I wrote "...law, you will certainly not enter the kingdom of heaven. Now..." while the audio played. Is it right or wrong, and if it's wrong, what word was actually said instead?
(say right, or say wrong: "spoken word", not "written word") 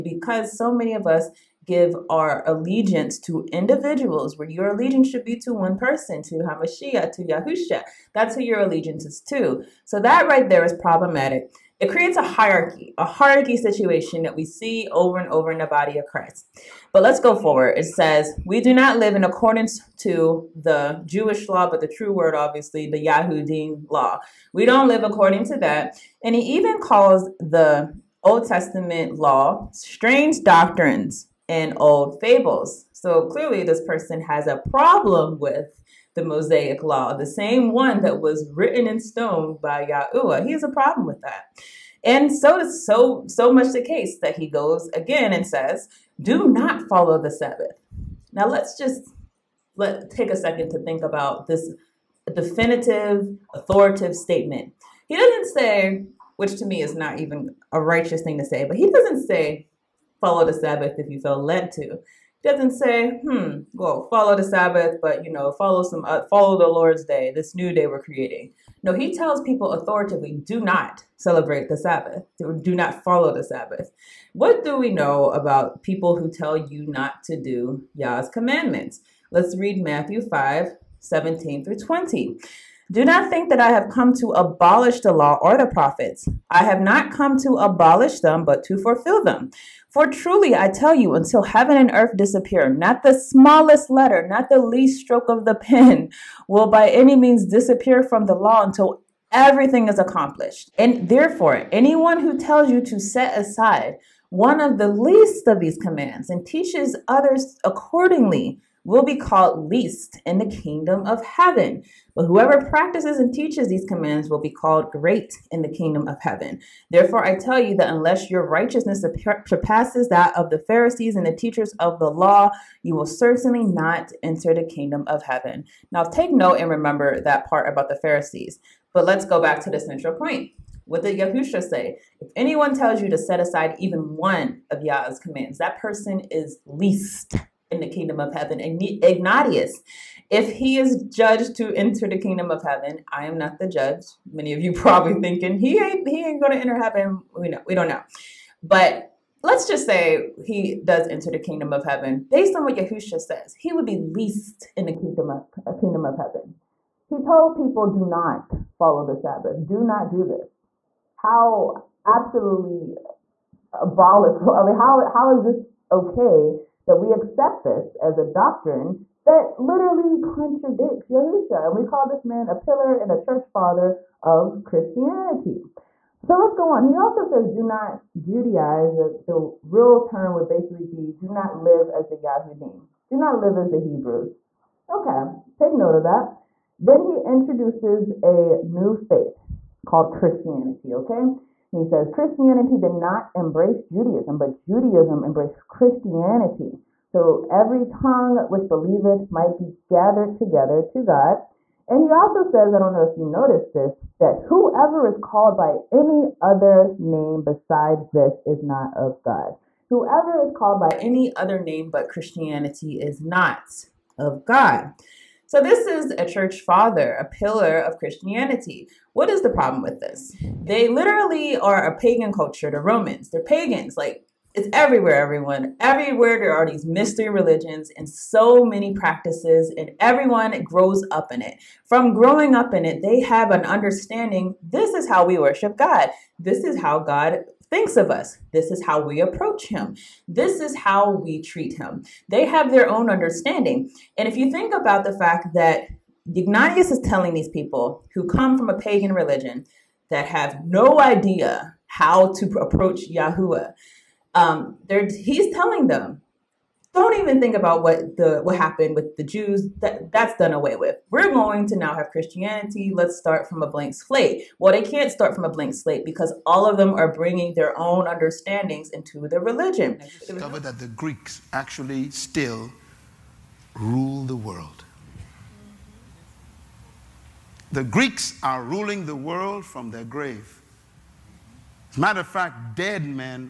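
right.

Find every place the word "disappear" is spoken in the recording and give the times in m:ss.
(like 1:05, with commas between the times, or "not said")
1:32, 1:37.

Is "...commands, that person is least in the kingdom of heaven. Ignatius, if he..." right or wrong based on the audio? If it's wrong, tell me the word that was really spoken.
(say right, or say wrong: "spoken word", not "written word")
right.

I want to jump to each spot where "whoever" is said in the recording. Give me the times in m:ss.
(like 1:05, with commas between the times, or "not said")
1:52, 3:24, 3:29.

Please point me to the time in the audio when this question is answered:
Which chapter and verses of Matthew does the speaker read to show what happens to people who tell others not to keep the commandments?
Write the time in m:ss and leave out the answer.
1:19.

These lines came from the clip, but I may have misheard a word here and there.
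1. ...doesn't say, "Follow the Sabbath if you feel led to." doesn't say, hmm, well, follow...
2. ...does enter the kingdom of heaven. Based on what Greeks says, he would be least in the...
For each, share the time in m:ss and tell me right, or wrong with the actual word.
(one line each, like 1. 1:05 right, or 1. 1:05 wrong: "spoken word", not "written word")
1. 0:58 right
2. 2:30 wrong: "Yahushua", not "Greeks".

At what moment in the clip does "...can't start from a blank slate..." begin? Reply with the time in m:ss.
4:24.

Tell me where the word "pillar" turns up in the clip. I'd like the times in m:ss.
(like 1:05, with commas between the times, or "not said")
2:52, 3:37.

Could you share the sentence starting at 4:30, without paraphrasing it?
Discover that the Greeks actually still rule the world.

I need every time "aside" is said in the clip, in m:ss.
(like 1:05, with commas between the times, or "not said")
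1:43, 2:13.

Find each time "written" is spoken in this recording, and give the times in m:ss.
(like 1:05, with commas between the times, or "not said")
0:38.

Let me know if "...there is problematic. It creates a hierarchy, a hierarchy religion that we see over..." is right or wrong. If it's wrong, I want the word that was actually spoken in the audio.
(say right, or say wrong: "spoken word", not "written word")
wrong: "situation", not "religion".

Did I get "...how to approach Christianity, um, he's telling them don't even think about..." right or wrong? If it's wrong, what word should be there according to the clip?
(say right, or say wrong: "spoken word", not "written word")
wrong: "Yahuwah", not "Christianity".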